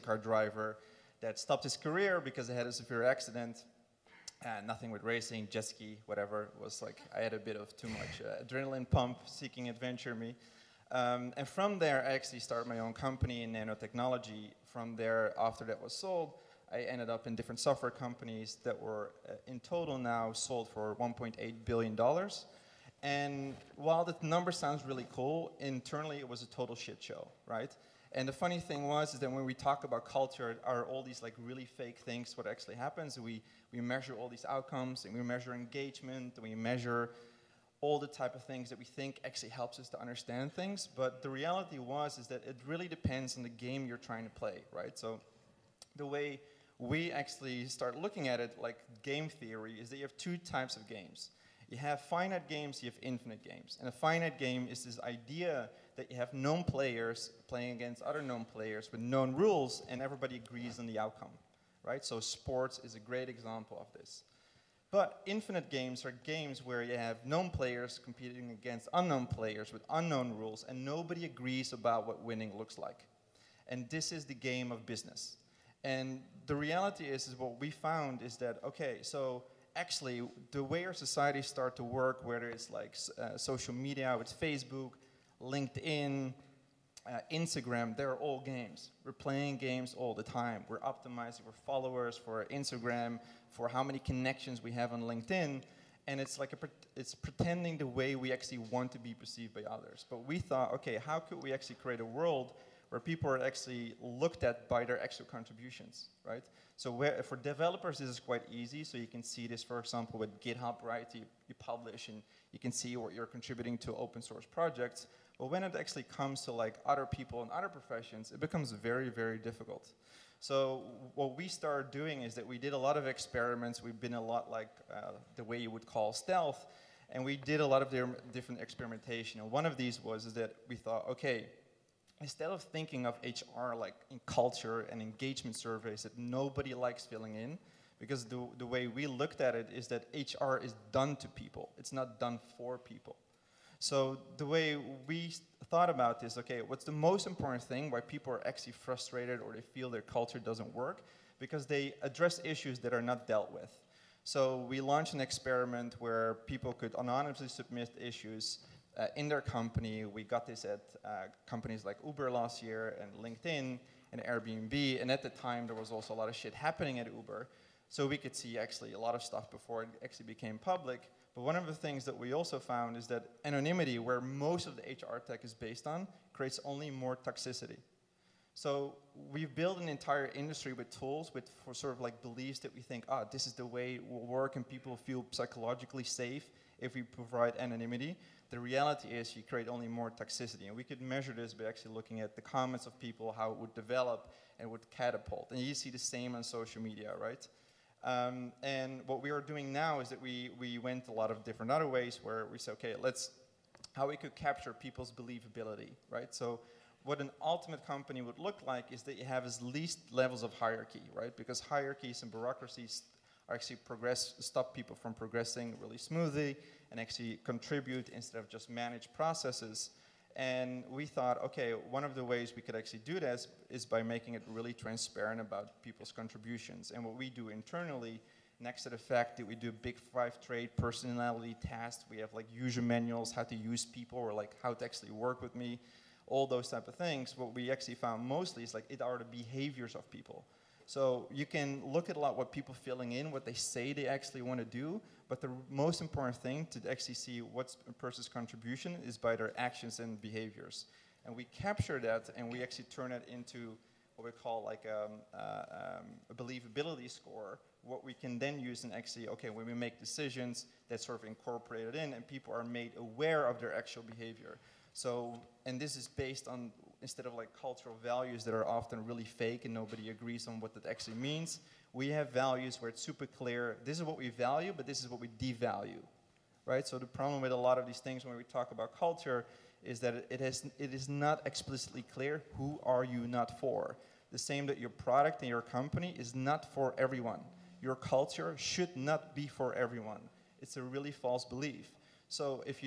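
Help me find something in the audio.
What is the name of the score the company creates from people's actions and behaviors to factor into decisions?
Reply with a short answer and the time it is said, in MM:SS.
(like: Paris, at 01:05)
believability score, at 04:16.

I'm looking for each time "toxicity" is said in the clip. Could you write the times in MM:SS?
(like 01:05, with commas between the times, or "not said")
02:57, 03:10.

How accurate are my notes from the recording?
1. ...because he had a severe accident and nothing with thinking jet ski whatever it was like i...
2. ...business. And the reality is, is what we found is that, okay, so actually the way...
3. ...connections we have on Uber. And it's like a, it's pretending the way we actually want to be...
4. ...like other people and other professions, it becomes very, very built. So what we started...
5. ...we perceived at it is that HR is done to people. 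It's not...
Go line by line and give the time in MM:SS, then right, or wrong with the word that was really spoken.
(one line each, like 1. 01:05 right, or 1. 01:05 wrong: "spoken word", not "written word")
1. 00:02 wrong: "racing", not "thinking"
2. 01:14 right
3. 01:33 wrong: "LinkedIn", not "Uber"
4. 01:56 wrong: "difficult", not "built"
5. 02:18 wrong: "looked", not "perceived".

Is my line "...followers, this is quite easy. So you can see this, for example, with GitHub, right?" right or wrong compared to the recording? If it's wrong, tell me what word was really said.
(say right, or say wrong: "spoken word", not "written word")
wrong: "developers", not "followers".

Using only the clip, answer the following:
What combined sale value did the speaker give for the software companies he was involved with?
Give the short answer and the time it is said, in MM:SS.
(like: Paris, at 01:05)
$1.8 billion, at 00:20.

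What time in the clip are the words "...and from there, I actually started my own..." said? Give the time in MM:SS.
00:11.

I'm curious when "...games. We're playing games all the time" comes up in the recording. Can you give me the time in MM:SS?
01:28.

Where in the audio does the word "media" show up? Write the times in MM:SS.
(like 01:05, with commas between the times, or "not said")
01:23, 03:16.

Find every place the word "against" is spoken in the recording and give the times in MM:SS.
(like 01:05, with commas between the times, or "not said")
00:57, 01:08.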